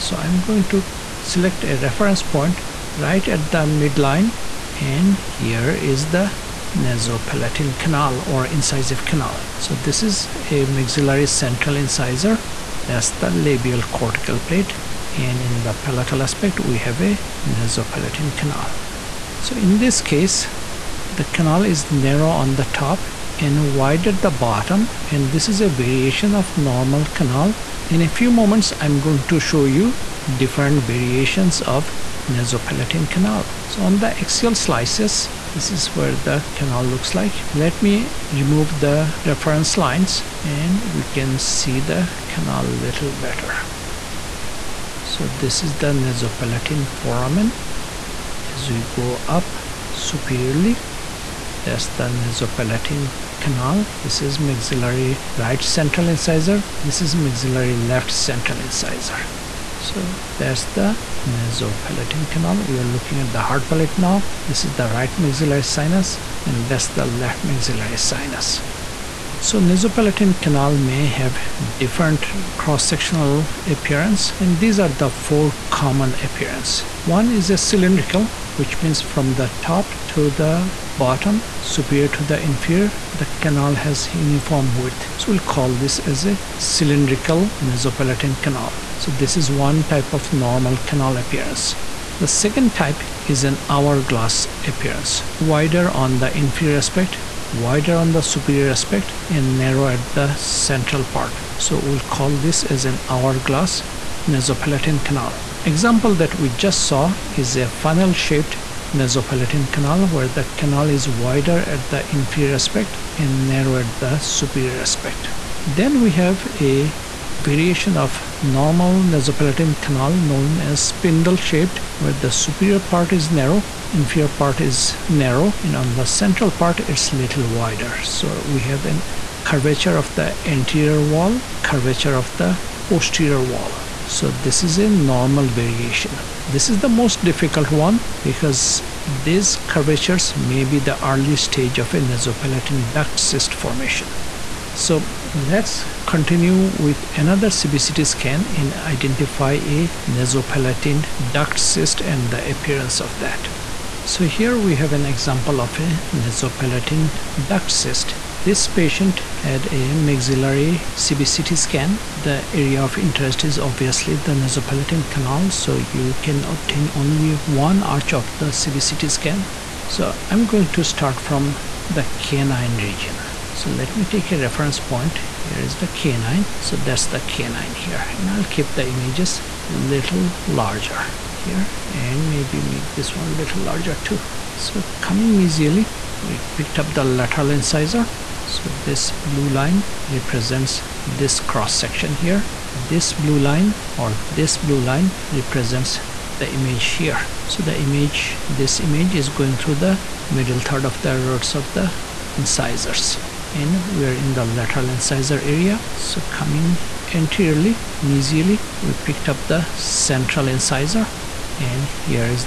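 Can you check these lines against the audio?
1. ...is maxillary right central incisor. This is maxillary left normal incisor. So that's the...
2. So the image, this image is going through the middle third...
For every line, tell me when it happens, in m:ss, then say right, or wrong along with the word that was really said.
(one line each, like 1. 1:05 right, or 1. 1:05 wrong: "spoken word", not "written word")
1. 0:54 wrong: "central", not "normal"
2. 3:17 right.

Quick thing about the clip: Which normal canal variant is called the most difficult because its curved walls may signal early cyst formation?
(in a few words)
Spindle shaped.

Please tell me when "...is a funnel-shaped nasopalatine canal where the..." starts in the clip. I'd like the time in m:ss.
1:47.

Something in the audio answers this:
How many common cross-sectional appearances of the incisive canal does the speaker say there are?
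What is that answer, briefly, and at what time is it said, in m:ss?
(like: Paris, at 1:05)
4, at 1:15.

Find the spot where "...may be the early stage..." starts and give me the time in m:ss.
2:20.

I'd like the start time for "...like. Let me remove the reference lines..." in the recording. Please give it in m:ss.
0:37.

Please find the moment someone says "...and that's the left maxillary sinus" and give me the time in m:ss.
1:06.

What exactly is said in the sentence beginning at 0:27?
In a few moments, I'm going to show you different variations of nasopalatine canal.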